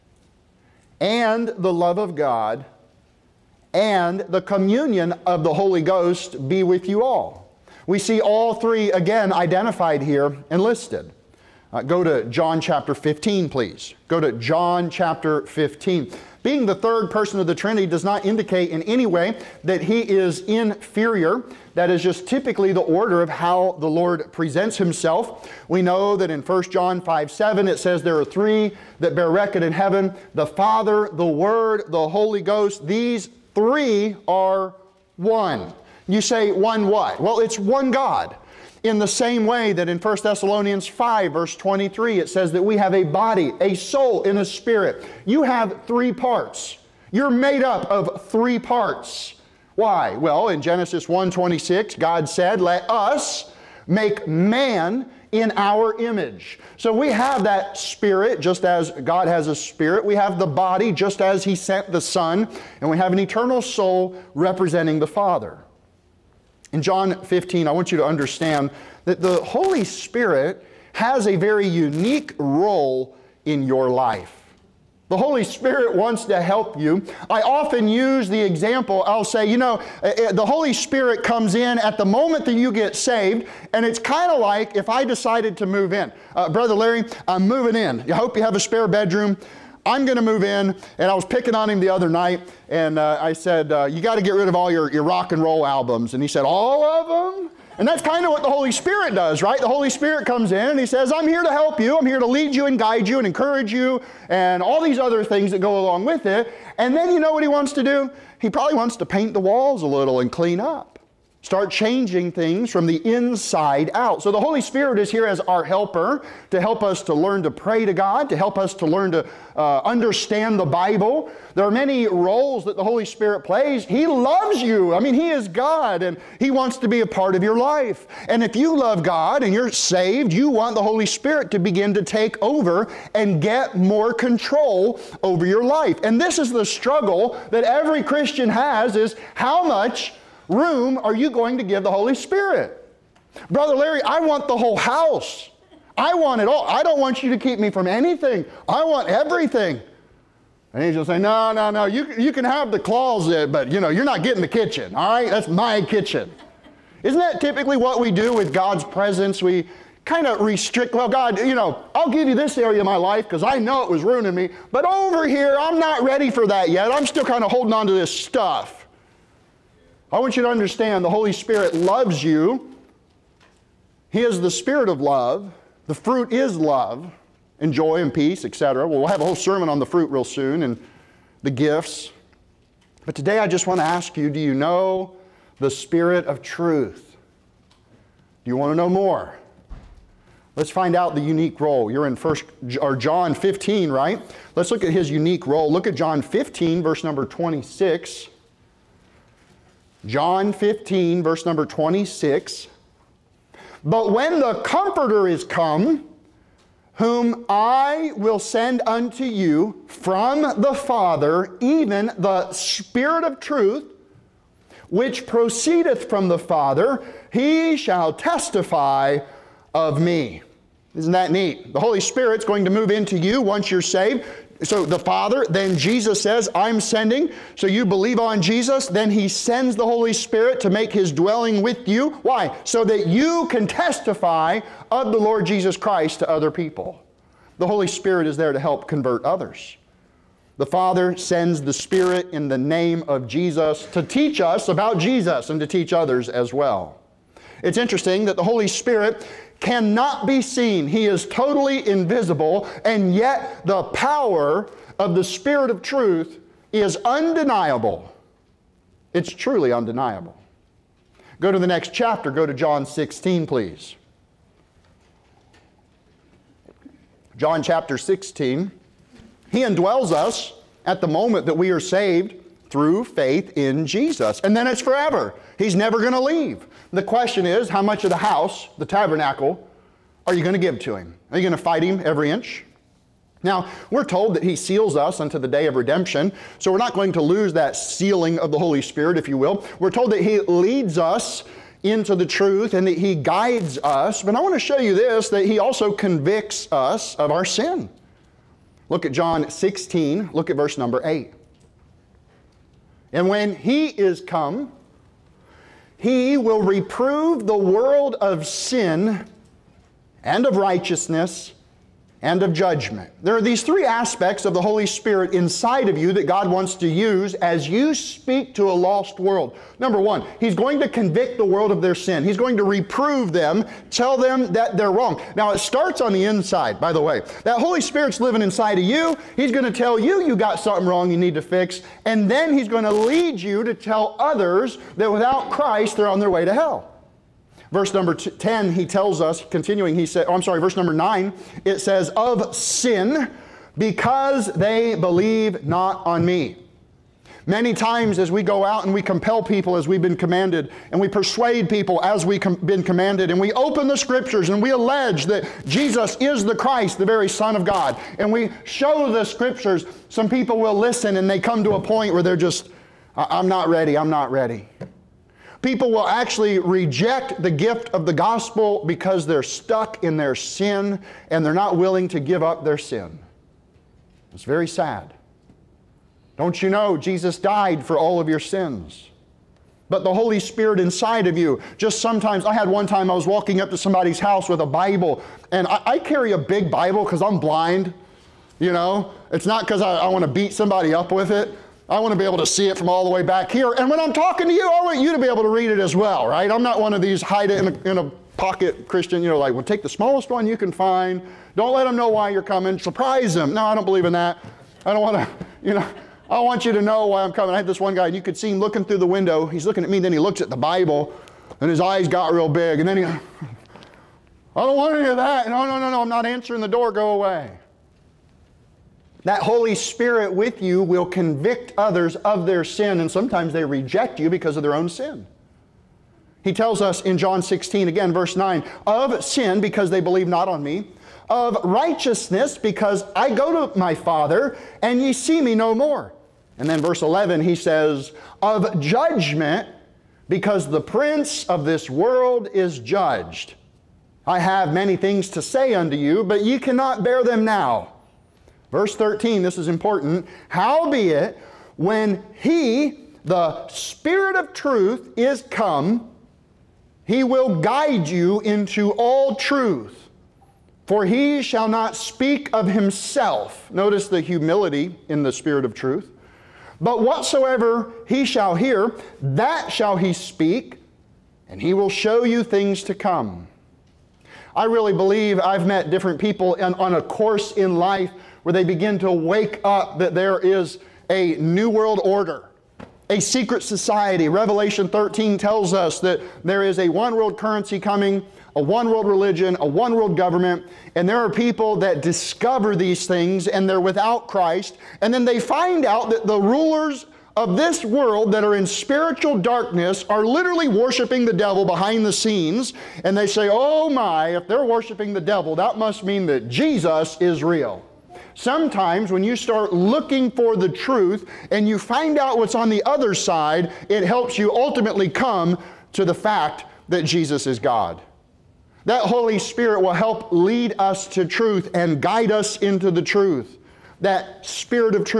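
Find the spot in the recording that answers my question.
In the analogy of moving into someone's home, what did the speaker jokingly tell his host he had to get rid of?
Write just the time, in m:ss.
1:35.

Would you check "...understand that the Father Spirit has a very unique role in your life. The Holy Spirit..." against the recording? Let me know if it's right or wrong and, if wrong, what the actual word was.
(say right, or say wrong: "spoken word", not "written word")
wrong: "Holy", not "Father".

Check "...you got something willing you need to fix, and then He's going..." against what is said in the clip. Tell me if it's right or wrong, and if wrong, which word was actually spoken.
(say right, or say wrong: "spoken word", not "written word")
wrong: "wrong", not "willing".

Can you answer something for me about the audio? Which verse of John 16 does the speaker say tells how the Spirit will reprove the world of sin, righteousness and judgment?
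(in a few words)
Verse 8.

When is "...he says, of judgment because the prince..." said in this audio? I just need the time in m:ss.
7:17.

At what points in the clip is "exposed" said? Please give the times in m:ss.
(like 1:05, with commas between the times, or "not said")
not said.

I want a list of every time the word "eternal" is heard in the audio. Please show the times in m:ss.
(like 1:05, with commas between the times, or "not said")
1:03.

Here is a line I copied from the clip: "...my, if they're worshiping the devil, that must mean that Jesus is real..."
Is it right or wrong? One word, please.
right.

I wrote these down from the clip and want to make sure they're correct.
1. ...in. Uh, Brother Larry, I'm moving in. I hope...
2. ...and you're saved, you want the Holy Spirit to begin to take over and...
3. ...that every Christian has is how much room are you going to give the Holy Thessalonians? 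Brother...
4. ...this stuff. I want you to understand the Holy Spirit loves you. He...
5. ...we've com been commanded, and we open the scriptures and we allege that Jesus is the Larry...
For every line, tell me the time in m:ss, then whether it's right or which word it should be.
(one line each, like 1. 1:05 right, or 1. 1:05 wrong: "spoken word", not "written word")
1. 1:25 right
2. 2:09 right
3. 2:17 wrong: "Spirit", not "Thessalonians"
4. 2:47 right
5. 5:52 wrong: "Christ", not "Larry".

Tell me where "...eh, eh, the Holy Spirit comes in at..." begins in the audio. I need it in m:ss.
1:20.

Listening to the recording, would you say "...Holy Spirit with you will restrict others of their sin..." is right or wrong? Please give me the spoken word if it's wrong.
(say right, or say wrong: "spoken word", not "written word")
wrong: "convict", not "restrict".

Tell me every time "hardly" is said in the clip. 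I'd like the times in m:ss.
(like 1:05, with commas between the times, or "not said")
not said.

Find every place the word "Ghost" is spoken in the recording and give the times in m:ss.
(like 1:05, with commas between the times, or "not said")
0:05, 0:32.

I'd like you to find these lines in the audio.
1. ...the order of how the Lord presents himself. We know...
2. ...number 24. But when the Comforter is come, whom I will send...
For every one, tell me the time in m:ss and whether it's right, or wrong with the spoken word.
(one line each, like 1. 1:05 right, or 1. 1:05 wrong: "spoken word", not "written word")
1. 0:22 right
2. 3:21 wrong: "26", not "24".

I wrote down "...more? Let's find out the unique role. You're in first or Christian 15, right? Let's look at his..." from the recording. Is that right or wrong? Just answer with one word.
wrong.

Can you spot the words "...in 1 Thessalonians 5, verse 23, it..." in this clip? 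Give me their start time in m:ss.
0:39.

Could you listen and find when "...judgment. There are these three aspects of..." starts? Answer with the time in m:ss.
5:12.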